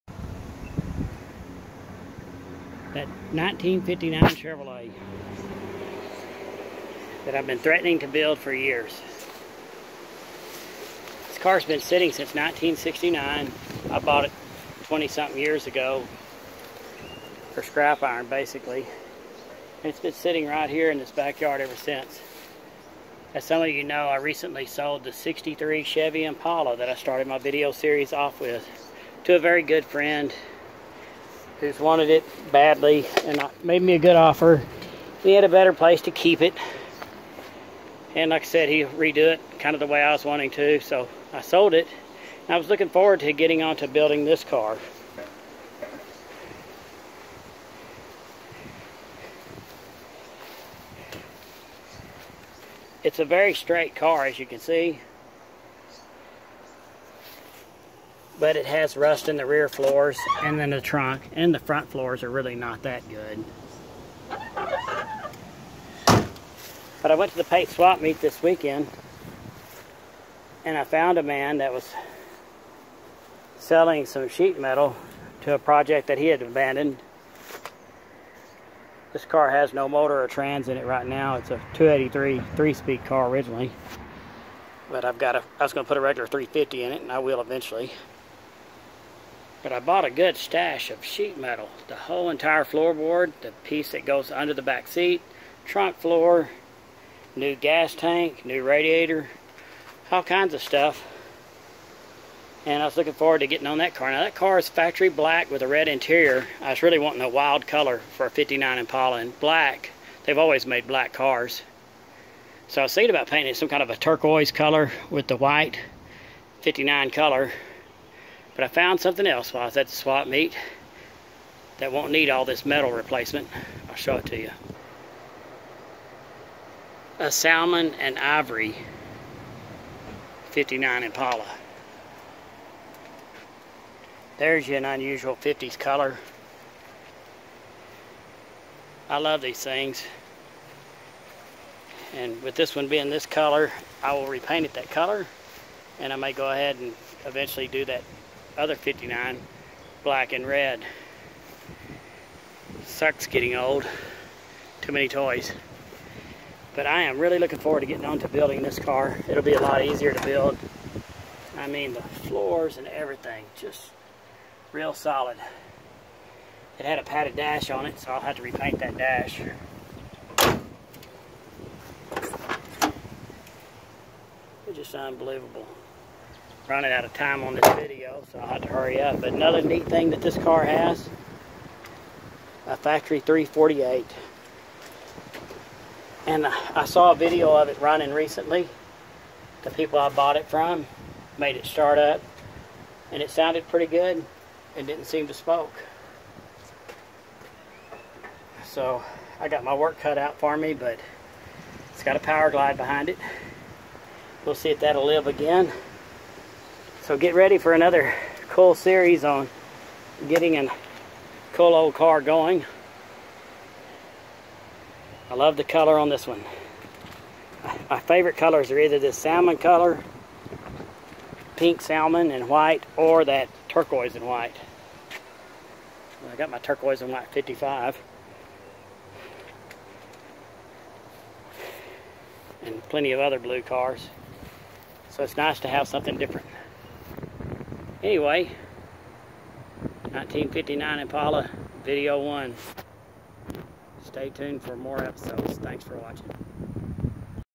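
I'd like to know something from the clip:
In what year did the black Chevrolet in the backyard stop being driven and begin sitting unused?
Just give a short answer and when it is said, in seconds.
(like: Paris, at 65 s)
1969, at 12 s.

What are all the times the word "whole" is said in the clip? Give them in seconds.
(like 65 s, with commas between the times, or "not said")
91 s.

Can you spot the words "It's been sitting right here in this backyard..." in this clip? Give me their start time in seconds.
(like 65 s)
19 s.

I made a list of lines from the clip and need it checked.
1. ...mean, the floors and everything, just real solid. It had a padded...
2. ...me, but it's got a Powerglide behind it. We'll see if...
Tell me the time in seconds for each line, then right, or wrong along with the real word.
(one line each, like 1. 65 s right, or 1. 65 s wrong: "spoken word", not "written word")
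1. 161 s right
2. 200 s right.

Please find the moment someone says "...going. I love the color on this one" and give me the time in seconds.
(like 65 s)
212 s.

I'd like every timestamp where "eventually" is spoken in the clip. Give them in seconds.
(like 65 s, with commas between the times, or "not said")
87 s, 147 s.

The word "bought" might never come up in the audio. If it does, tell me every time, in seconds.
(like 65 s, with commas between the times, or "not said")
13 s, 89 s, 190 s.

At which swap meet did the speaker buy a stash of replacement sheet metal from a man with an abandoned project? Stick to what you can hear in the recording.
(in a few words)
Pate swap meet.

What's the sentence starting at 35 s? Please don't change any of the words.
We had a better place to keep it.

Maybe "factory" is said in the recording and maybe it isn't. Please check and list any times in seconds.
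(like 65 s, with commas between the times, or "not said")
104 s, 182 s.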